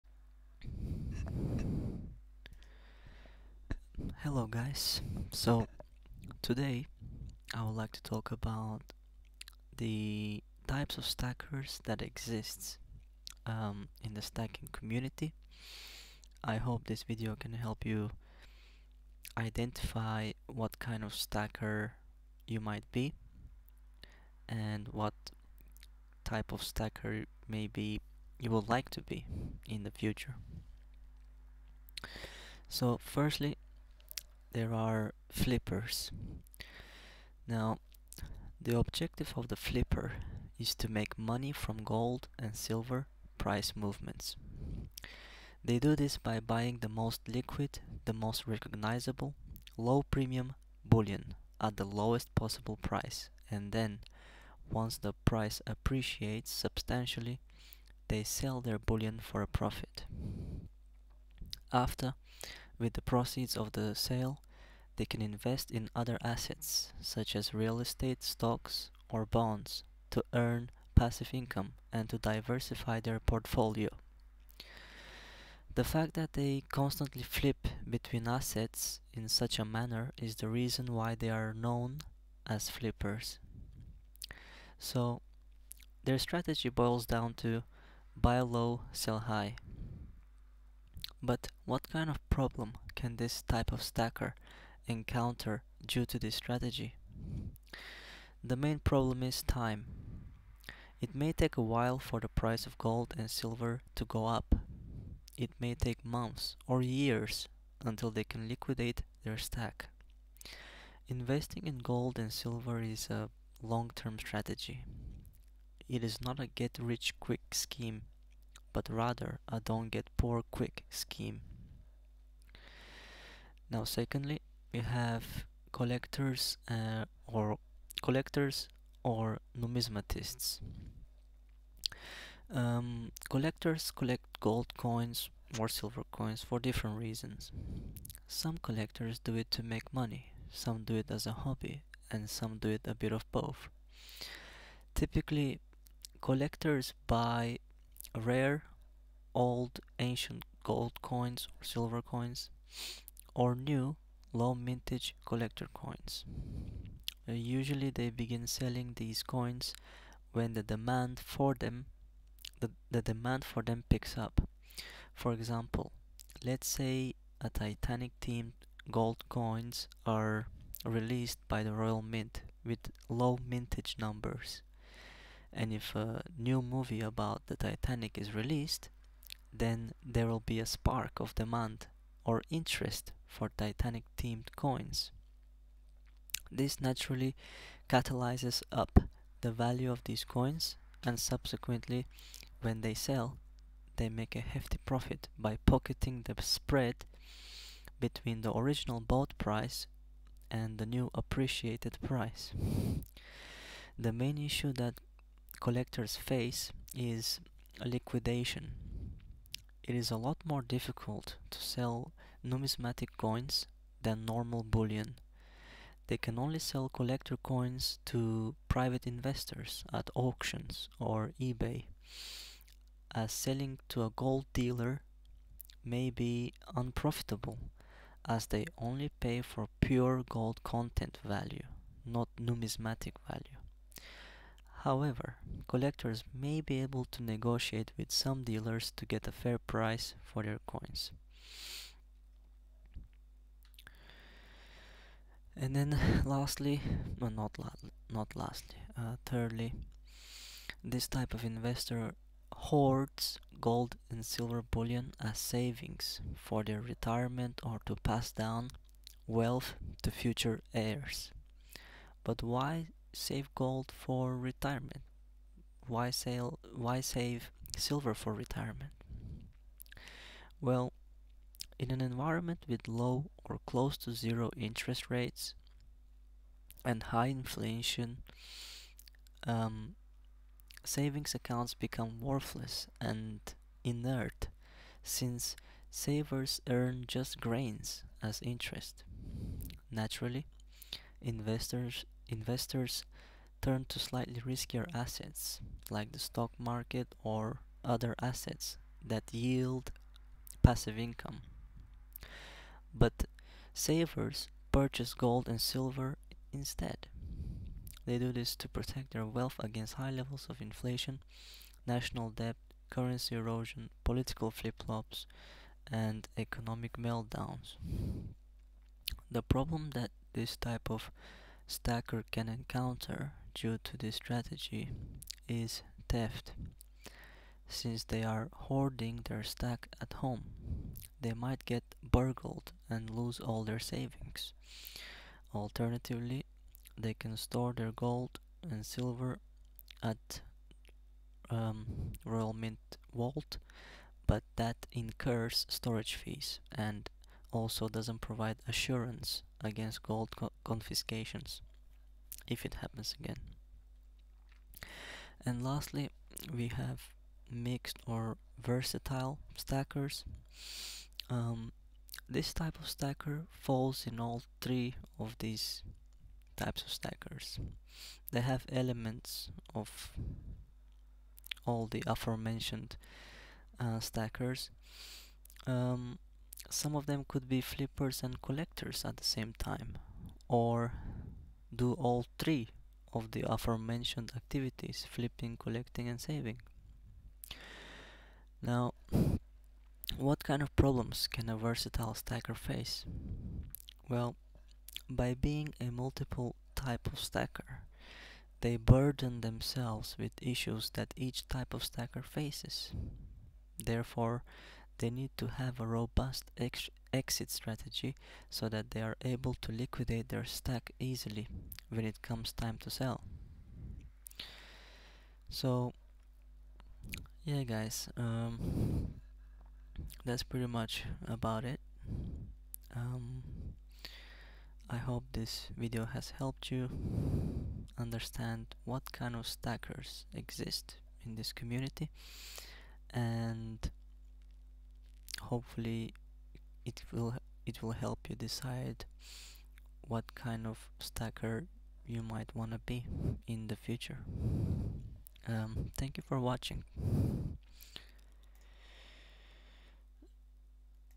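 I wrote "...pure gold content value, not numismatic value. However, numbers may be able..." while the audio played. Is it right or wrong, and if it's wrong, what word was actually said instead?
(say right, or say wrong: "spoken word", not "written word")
wrong: "collectors", not "numbers".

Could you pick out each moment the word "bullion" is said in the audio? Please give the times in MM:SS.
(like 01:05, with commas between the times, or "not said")
00:50, 00:58, 03:34, 04:14.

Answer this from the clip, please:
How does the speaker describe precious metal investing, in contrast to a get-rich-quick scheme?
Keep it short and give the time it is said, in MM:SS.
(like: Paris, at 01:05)
Don't get poor quick scheme, at 01:59.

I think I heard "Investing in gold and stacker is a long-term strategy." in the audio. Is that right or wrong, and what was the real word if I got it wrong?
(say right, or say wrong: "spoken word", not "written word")
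wrong: "silver", not "stacker".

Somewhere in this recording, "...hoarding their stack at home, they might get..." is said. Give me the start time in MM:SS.
05:28.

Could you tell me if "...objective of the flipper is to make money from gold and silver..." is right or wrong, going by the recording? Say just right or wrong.
right.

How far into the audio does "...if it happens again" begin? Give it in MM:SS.
05:52.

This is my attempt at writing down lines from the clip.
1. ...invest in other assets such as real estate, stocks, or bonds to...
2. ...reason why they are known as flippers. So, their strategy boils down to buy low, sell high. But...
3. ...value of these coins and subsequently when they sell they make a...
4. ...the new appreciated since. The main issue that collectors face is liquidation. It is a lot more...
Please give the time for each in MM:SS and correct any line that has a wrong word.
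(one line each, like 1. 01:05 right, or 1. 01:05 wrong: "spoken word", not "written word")
1. 01:05 right
2. 01:20 right
3. 03:09 right
4. 03:20 wrong: "price", not "since".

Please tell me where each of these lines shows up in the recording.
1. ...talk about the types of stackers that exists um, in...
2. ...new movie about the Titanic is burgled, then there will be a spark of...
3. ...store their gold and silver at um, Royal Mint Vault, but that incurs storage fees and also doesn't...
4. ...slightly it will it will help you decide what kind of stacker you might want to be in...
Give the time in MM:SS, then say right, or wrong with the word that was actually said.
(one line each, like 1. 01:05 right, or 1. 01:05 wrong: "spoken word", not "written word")
1. 00:08 right
2. 02:56 wrong: "released", not "burgled"
3. 05:37 right
4. 07:15 wrong: "hopefully", not "slightly".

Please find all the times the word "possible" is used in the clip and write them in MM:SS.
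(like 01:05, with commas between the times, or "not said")
00:52.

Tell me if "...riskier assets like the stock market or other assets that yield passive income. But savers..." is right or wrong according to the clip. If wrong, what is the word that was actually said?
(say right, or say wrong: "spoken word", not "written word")
right.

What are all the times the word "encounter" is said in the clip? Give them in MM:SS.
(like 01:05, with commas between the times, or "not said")
01:34, 05:22.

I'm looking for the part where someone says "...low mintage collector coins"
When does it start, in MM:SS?
02:34.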